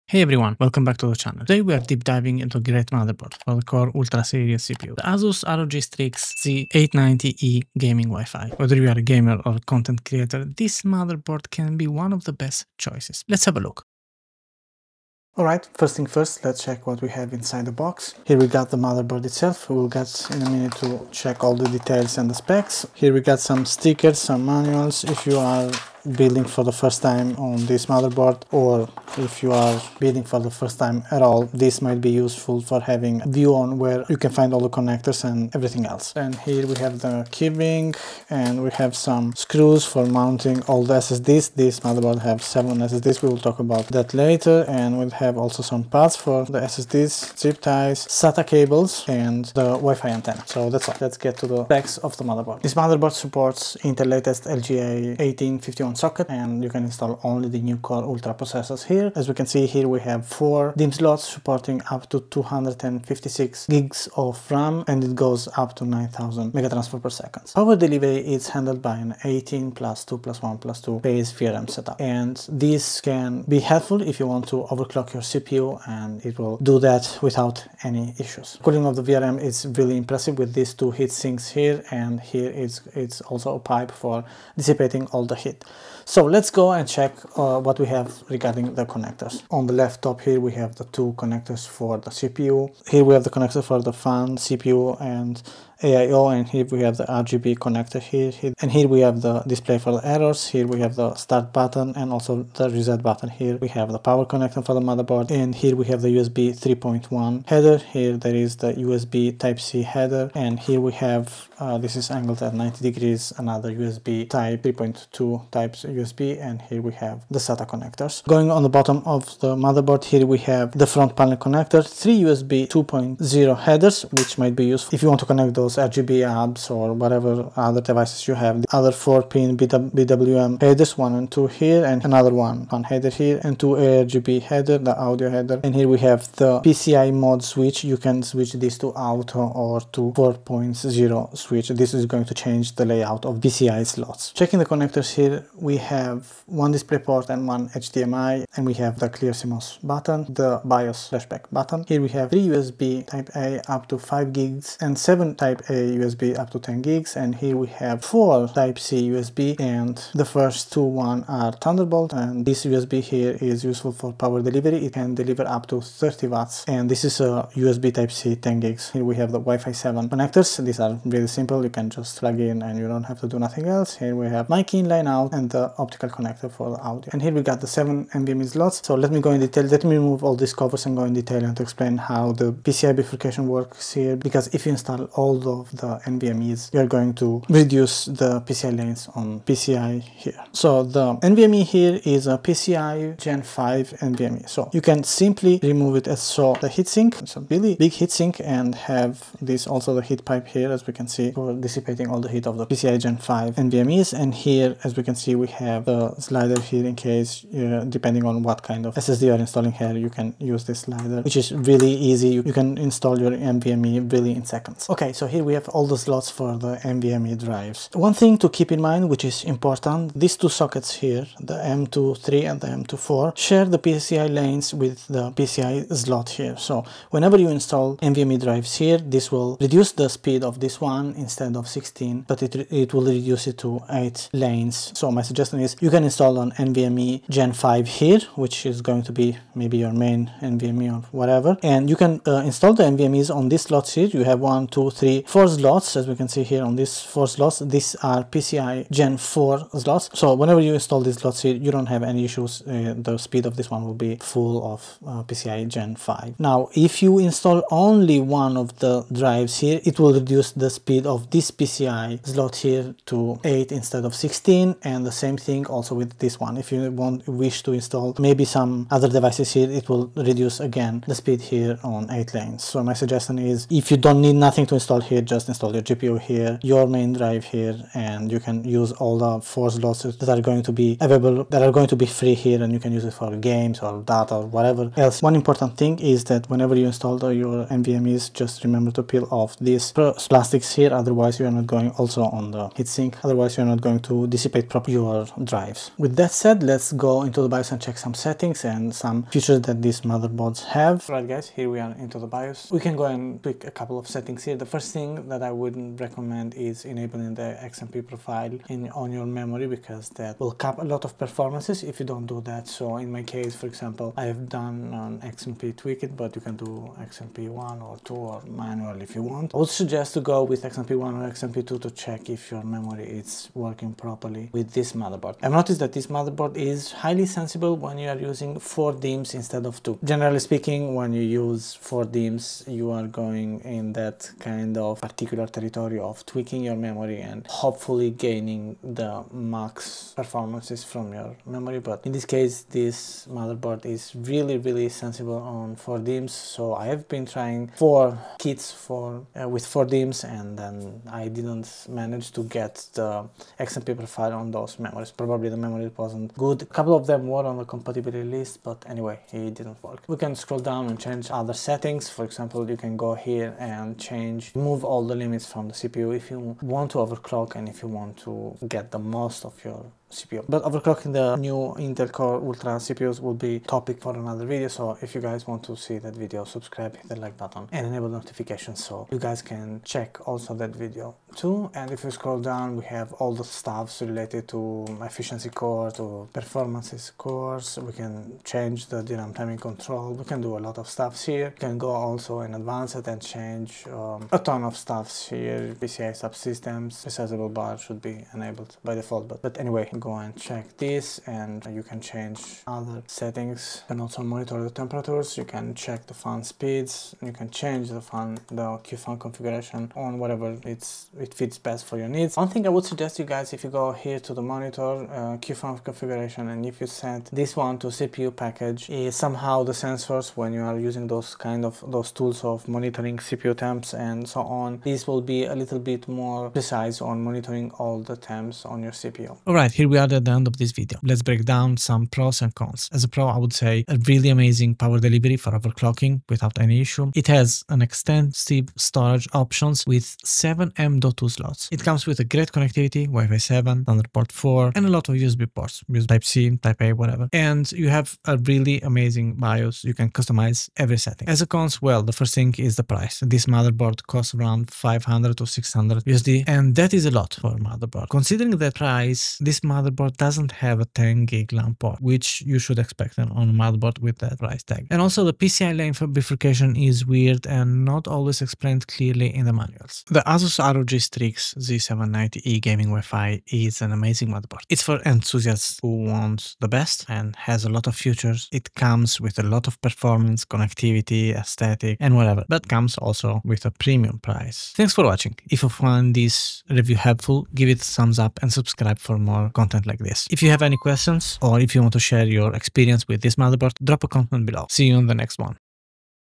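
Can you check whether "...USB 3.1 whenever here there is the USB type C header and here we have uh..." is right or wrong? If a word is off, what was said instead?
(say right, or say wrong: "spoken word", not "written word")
wrong: "header", not "whenever".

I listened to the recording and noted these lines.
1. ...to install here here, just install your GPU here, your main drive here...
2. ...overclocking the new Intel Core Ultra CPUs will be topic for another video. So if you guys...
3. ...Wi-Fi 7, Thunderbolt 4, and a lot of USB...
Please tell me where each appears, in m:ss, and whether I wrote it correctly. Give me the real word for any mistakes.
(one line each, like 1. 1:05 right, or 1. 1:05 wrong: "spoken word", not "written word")
1. 4:34 right
2. 6:10 right
3. 7:23 right.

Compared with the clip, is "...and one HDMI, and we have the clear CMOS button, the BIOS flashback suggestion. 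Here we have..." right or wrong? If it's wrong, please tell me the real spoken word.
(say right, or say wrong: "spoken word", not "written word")
wrong: "button", not "suggestion".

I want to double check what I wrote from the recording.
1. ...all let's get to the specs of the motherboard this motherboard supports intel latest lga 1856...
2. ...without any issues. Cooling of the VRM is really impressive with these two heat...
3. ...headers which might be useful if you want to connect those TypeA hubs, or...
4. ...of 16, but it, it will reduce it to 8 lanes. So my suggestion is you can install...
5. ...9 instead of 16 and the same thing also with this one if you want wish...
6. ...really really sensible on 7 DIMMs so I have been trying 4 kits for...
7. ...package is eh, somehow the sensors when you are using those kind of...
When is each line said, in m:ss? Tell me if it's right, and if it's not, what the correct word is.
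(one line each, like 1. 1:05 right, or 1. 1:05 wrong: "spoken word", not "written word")
1. 0:50 wrong: "1851", not "1856"
2. 1:17 right
3. 2:03 wrong: "RGB", not "TypeA"
4. 3:51 right
5. 4:23 wrong: "8", not "9"
6. 5:44 wrong: "4", not "7"
7. 6:58 right.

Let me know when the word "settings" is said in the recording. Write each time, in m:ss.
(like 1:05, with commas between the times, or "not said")
4:58, 5:04, 6:01, 6:43, 7:30.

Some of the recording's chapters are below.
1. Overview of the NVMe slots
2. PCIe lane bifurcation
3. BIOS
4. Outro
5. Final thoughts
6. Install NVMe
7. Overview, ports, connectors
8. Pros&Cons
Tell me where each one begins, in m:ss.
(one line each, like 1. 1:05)
1. 2:55
2. 3:35
3. 5:00
4. 8:06
5. 7:51
6. 4:45
7. 0:55
8. 7:10.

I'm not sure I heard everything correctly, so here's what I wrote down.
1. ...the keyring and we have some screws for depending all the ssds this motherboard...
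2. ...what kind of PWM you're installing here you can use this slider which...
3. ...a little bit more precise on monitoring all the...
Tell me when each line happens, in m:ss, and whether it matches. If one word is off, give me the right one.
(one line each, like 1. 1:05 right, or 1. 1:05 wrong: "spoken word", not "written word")
1. 0:36 wrong: "mounting", not "depending"
2. 3:28 wrong: "SSD", not "PWM"
3. 7:05 right.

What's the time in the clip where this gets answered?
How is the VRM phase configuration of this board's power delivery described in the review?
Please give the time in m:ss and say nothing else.
1:09.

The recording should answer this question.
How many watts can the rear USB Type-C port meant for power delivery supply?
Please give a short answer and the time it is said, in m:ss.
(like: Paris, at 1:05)
30 watts, at 2:45.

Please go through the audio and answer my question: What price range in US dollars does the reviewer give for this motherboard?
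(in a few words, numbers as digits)
500 to 600 USD.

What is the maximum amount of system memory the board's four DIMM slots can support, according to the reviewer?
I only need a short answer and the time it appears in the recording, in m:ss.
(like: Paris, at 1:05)
256 GB, at 1:02.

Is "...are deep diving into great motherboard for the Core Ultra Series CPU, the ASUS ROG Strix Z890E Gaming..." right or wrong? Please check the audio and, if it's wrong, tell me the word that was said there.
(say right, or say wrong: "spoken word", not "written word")
right.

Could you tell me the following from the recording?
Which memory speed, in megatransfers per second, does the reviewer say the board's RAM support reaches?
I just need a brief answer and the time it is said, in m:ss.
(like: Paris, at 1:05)
9000, at 1:05.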